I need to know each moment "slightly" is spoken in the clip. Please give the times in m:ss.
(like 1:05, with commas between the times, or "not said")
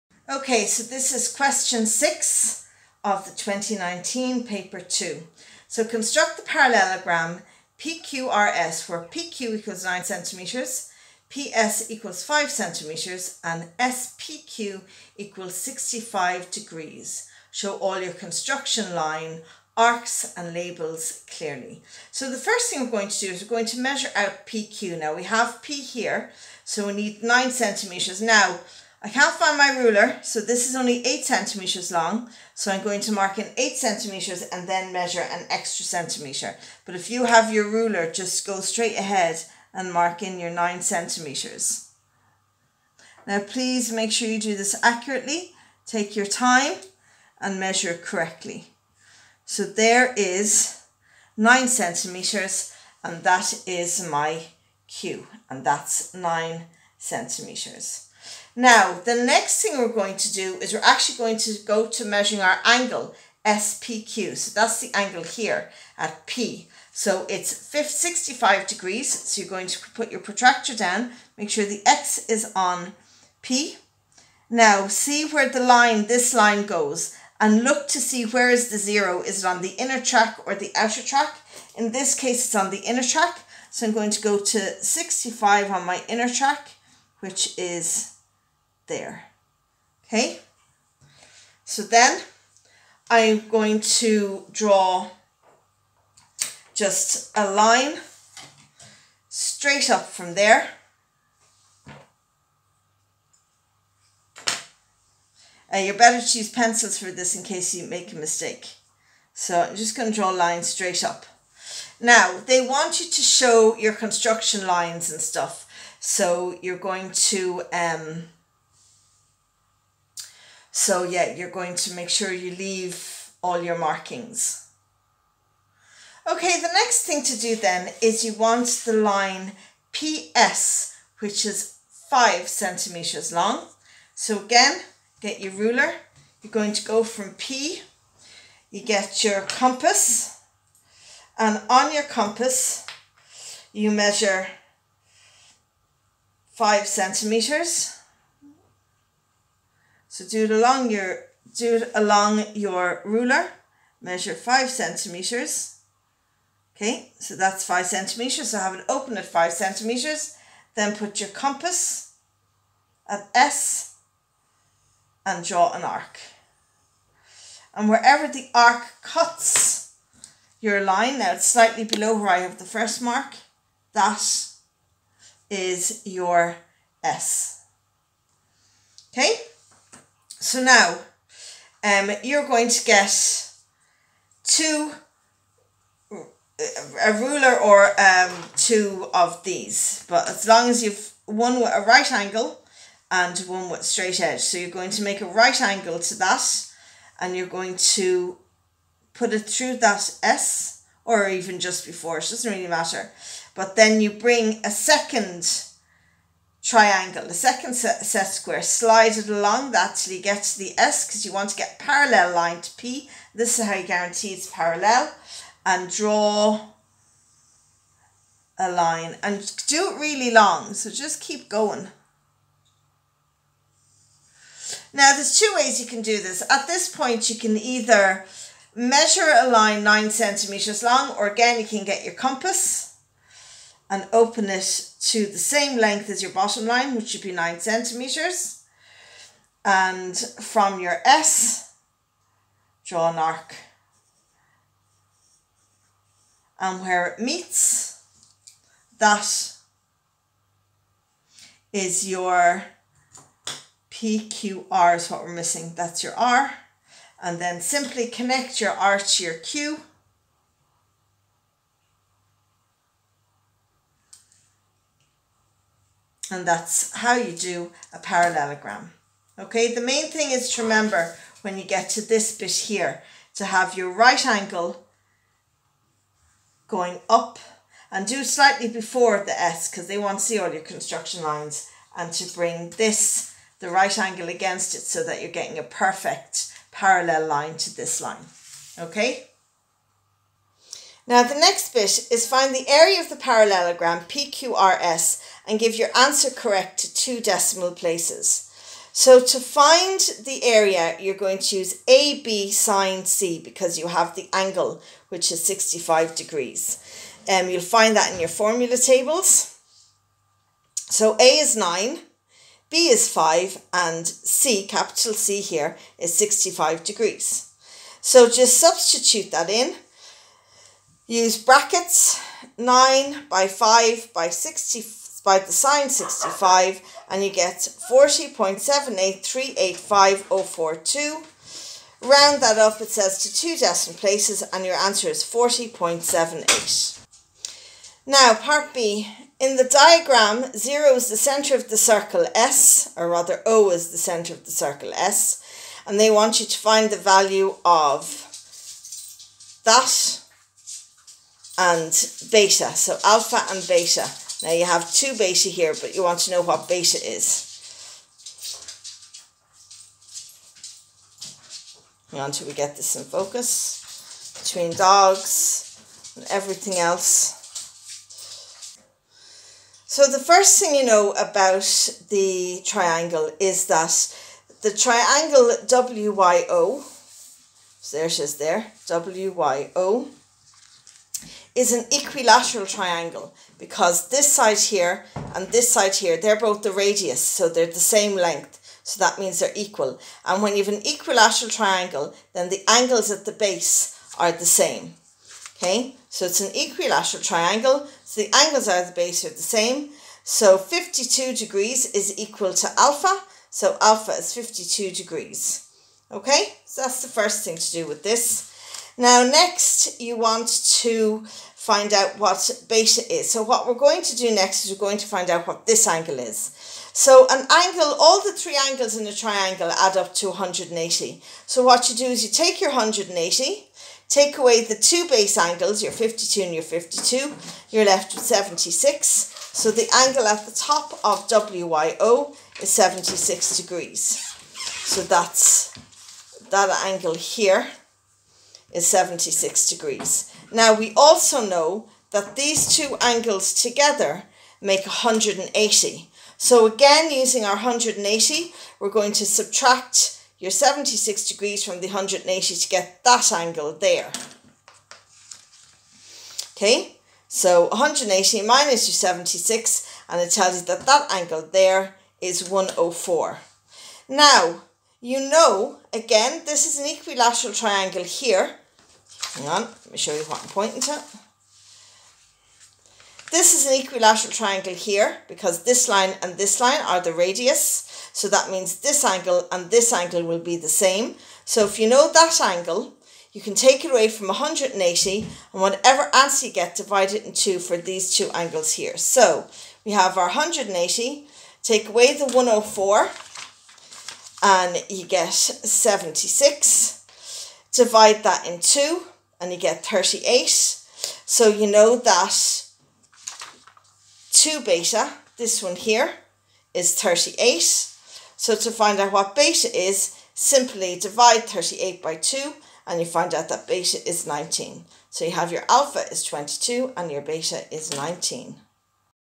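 2:51, 4:38.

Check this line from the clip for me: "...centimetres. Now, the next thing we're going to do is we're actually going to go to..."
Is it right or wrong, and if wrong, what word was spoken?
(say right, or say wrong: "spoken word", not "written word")
right.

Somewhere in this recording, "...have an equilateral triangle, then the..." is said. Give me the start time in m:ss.
6:30.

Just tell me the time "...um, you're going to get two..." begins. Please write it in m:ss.
3:01.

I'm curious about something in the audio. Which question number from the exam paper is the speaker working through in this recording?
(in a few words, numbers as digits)
6.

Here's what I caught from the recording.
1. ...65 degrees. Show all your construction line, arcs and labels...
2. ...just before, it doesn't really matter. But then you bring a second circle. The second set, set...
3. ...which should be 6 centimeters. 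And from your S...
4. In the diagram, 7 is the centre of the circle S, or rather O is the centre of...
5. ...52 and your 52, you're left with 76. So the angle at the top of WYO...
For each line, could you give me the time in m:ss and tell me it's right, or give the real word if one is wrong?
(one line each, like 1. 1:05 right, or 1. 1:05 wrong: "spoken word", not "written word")
1. 0:15 right
2. 3:21 wrong: "triangle", not "circle"
3. 3:56 wrong: "9", not "6"
4. 5:39 wrong: "0", not "7"
5. 7:05 right.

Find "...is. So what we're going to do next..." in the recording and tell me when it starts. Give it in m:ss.
6:53.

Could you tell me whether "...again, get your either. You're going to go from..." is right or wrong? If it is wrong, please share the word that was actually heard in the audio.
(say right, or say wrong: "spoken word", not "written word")
wrong: "ruler", not "either".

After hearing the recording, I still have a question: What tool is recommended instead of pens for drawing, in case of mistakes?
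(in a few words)
Pencils.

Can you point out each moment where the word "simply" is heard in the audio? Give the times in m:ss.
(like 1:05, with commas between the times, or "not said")
4:17, 8:30.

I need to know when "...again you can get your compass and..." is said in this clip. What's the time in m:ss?
3:51.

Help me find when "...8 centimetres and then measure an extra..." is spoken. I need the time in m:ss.
0:33.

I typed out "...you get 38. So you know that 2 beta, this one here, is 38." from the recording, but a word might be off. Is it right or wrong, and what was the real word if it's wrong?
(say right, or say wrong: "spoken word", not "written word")
right.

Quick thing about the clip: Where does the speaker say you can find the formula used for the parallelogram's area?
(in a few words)
Formula tables.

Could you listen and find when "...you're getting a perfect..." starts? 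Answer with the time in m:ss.
4:45.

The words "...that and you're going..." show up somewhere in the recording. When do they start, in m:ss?
3:16.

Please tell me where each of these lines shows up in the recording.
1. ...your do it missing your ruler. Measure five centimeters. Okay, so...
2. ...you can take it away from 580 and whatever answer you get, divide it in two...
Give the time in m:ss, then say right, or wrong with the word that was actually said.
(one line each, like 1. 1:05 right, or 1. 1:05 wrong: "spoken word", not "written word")
1. 2:30 wrong: "along", not "missing"
2. 8:03 wrong: "180", not "580".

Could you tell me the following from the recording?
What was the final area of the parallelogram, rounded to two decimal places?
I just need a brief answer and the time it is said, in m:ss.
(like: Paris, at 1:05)
40.78, at 5:35.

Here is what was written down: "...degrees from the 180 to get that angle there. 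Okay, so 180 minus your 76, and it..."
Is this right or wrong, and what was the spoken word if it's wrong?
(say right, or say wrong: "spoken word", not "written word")
right.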